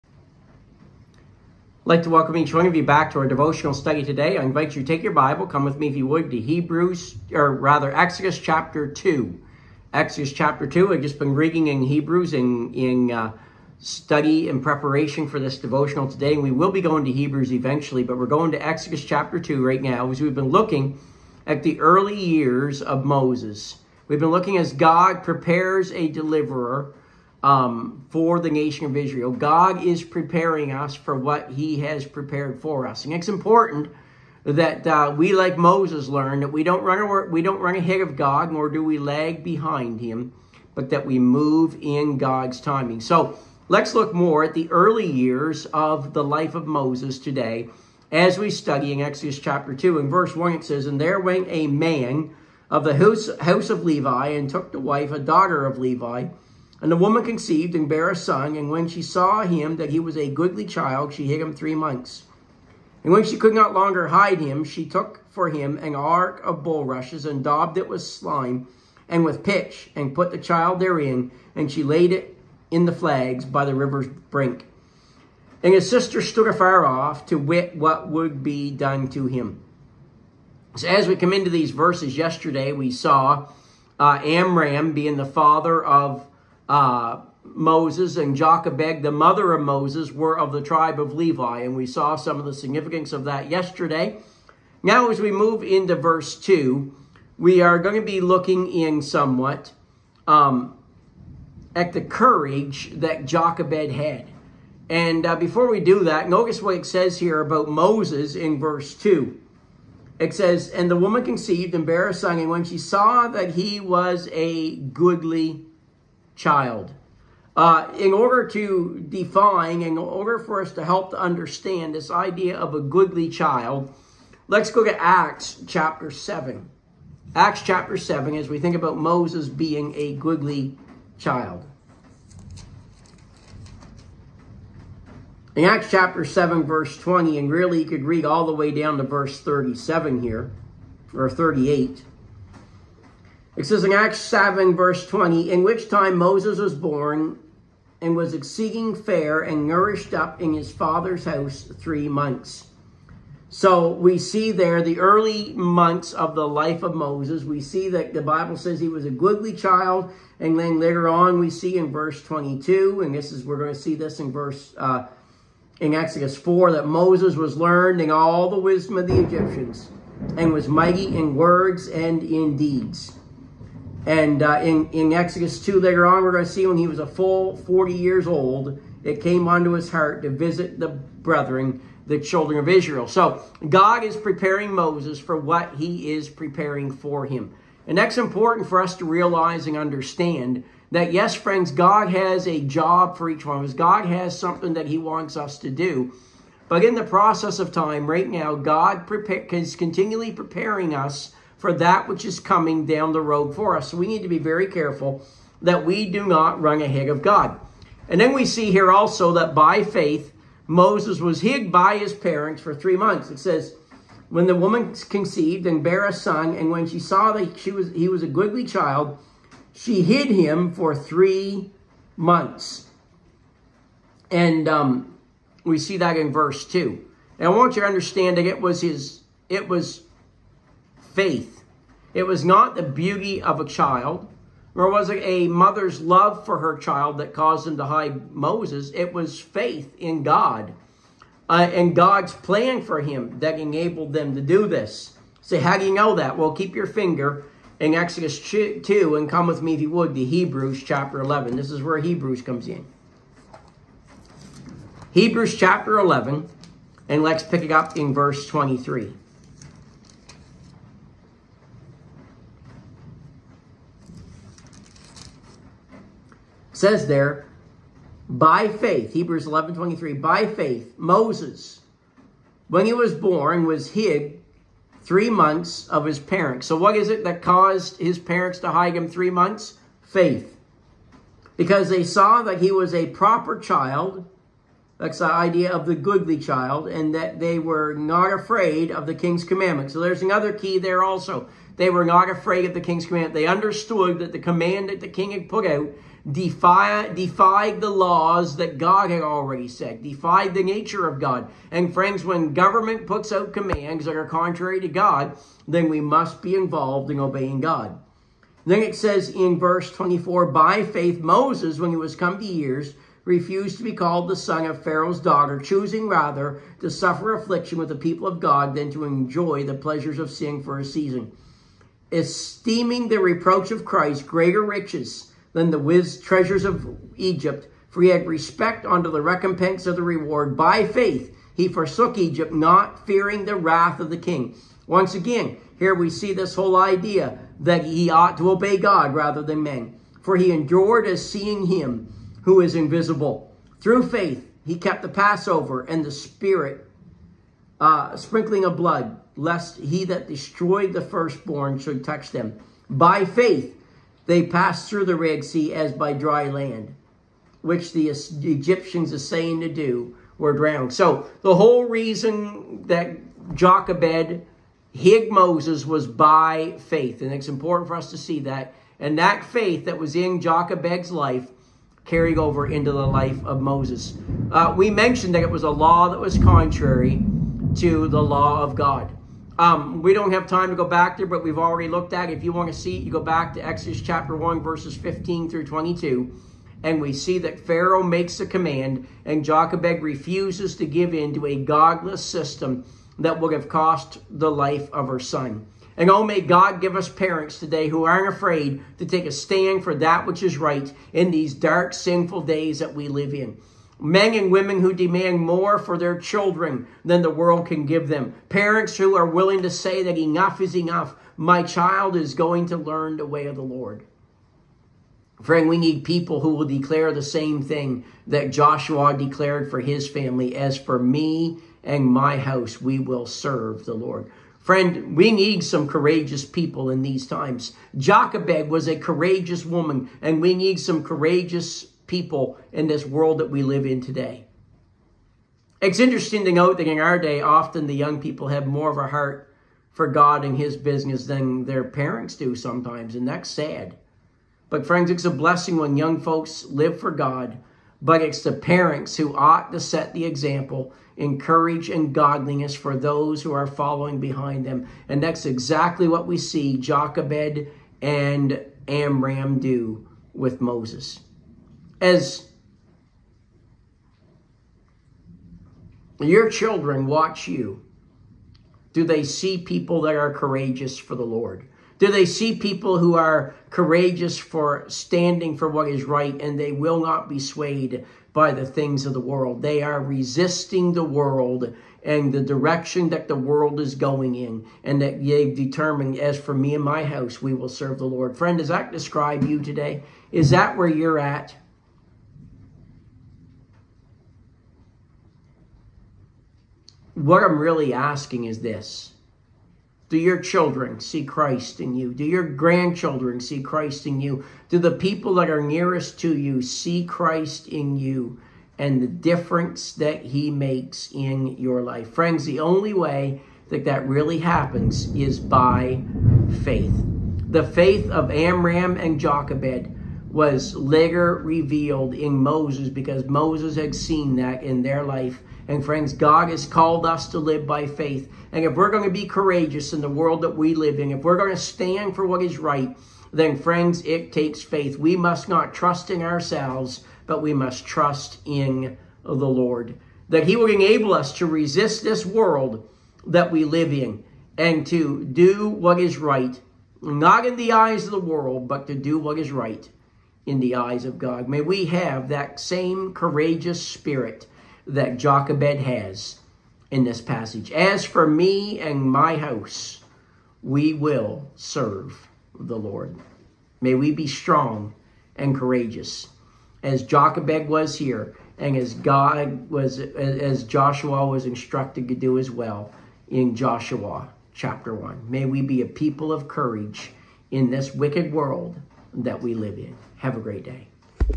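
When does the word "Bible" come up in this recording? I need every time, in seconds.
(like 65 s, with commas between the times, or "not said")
5 s, 158 s.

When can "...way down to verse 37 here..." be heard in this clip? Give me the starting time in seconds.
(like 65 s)
138 s.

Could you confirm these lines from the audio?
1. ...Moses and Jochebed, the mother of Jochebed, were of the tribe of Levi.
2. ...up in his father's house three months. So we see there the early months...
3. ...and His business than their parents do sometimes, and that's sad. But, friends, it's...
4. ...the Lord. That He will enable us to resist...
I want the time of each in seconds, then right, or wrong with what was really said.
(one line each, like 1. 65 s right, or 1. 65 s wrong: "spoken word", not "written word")
1. 87 s wrong: "Moses", not "Jochebed"
2. 150 s right
3. 440 s right
4. 539 s right.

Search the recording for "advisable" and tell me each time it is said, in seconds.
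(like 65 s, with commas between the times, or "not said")
not said.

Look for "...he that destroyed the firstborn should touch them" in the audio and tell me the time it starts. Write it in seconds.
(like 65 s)
349 s.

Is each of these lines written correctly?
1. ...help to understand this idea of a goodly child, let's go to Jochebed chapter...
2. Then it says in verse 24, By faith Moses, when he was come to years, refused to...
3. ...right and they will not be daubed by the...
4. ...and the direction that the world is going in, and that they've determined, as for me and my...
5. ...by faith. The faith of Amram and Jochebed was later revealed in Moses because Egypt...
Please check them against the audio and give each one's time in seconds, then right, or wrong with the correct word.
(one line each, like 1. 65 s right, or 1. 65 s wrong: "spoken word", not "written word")
1. 120 s wrong: "Acts", not "Jochebed"
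2. 308 s right
3. 476 s wrong: "swayed", not "daubed"
4. 482 s right
5. 515 s wrong: "Moses", not "Egypt".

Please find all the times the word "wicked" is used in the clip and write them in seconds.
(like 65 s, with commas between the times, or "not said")
577 s.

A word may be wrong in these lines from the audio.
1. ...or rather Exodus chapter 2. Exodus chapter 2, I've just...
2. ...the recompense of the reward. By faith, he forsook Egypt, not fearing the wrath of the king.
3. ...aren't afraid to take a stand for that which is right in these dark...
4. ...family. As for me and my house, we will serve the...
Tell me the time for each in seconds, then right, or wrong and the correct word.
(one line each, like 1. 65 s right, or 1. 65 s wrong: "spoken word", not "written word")
1. 7 s right
2. 329 s right
3. 398 s right
4. 420 s right.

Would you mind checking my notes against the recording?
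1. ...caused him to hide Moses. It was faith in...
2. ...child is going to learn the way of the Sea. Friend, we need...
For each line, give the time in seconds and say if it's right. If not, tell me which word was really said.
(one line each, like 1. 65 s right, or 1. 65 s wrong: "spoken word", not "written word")
1. 237 s right
2. 411 s wrong: "Lord", not "Sea".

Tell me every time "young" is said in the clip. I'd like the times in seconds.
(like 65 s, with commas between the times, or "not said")
437 s, 445 s.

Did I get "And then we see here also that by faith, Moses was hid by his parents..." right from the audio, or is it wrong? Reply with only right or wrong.
right.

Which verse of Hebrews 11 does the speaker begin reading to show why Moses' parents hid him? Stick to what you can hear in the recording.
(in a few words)
Verse 23.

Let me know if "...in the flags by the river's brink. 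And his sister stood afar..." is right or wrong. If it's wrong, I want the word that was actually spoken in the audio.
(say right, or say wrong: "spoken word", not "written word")
right.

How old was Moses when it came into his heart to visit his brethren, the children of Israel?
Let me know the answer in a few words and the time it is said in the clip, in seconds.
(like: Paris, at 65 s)
40, at 177 s.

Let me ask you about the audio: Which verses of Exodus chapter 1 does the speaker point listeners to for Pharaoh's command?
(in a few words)
15 through 22.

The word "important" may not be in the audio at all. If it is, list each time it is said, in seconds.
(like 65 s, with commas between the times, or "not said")
33 s, 188 s, 367 s.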